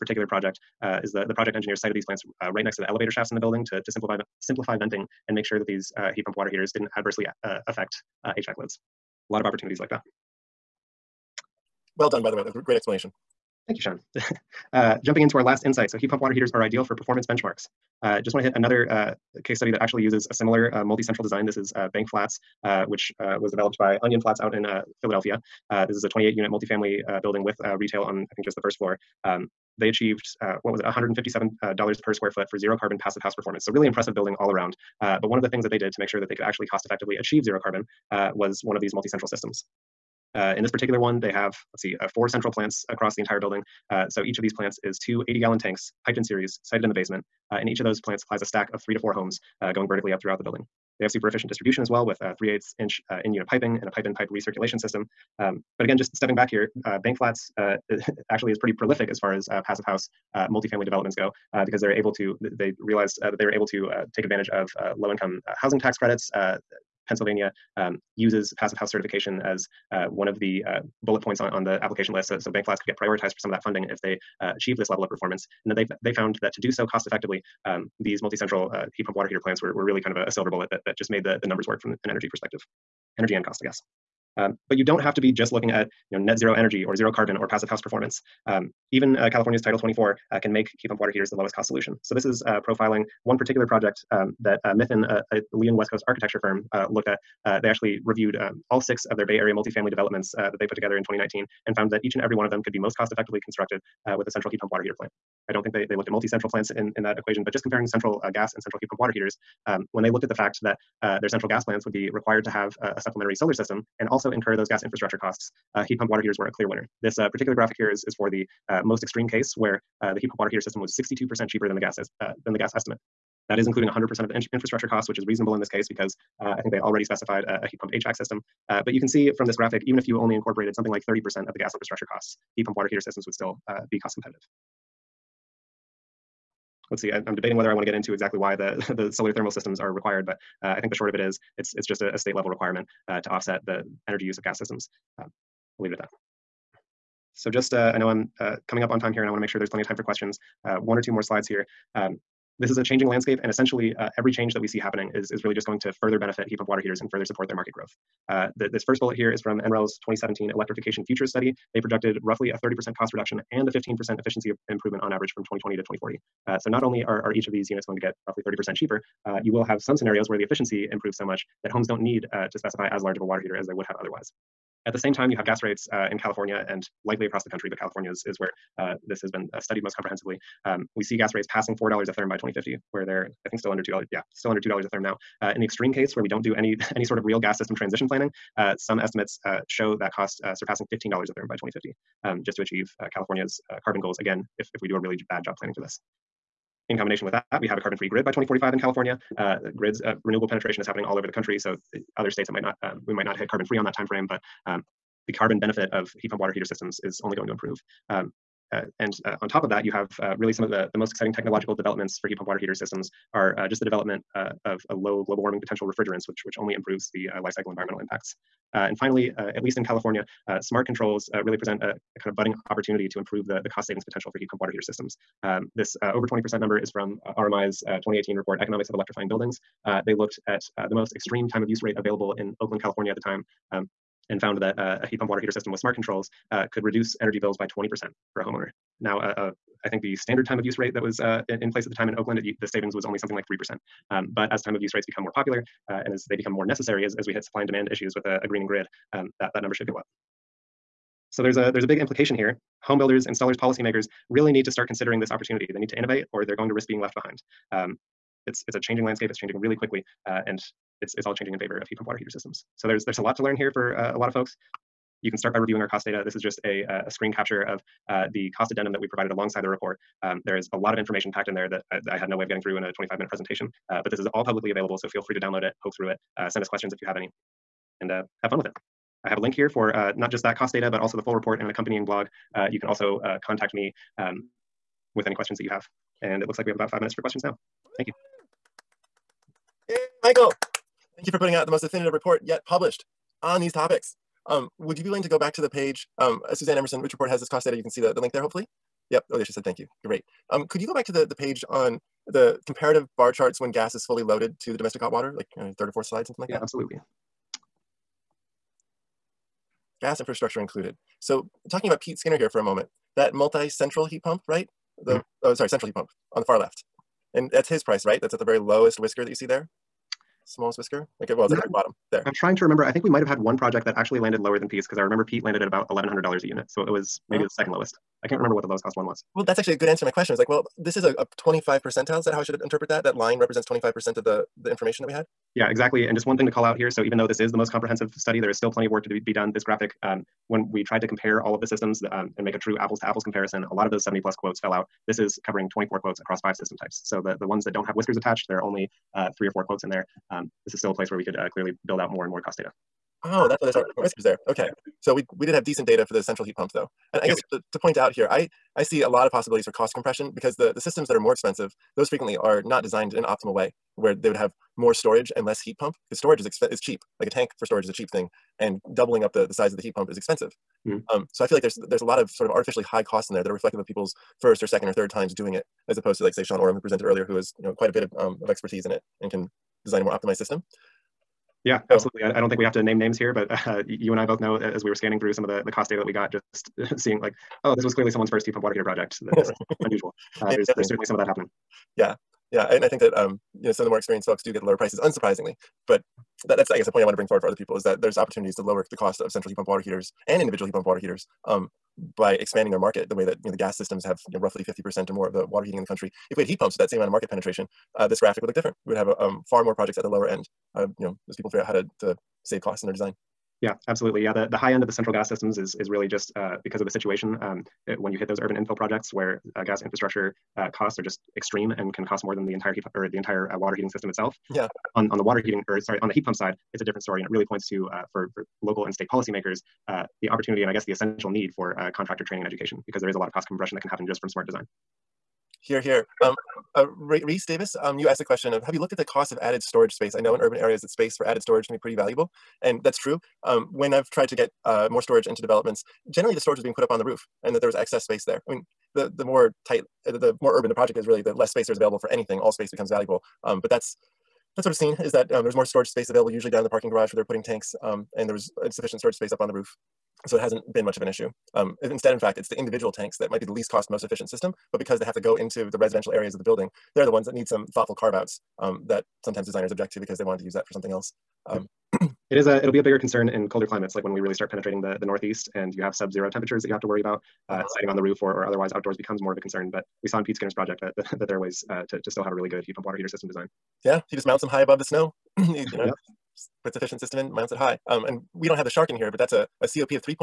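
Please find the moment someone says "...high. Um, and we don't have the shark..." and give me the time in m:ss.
8:07.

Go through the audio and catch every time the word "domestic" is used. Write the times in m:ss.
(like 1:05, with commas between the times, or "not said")
5:04.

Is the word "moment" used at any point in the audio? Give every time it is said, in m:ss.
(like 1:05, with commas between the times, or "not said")
5:12.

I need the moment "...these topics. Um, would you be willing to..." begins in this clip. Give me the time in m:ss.
4:53.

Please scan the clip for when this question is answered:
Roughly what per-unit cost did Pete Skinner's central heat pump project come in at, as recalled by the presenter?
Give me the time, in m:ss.
5:25.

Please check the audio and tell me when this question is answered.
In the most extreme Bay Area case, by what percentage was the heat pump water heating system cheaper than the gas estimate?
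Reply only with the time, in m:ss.
2:00.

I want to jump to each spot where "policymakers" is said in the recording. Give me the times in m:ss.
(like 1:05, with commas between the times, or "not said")
4:13, 7:09.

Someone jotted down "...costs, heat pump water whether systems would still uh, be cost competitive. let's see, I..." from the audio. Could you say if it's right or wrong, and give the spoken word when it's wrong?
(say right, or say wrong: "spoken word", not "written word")
wrong: "heater", not "whether".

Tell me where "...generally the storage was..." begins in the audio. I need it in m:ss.
7:26.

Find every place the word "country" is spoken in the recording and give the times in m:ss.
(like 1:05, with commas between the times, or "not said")
2:57, 3:21, 6:45.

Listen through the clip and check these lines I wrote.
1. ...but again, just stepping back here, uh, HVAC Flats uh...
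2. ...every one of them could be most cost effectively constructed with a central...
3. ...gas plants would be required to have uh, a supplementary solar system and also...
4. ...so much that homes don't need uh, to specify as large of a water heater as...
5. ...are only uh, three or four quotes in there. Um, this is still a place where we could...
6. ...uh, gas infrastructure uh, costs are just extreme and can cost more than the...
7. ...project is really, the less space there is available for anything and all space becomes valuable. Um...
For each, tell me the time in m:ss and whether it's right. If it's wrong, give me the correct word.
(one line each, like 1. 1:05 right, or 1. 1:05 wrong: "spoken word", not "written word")
1. 0:55 wrong: "Bank", not "HVAC"
2. 1:42 right
3. 1:51 right
4. 2:51 right
5. 5:48 right
6. 6:59 right
7. 7:30 right.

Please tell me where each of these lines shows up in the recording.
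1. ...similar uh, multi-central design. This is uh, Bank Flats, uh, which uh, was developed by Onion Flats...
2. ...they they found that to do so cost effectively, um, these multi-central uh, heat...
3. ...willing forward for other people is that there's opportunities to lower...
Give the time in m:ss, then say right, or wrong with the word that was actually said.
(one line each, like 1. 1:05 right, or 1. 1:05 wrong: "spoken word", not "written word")
1. 0:20 right
2. 1:15 right
3. 6:37 wrong: "bring", not "willing".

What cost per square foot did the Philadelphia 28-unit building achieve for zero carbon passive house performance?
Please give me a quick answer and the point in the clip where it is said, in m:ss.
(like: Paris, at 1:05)
$157, at 0:30.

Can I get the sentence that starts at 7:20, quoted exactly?
I know in urban areas that space for added storage can be pretty valuable.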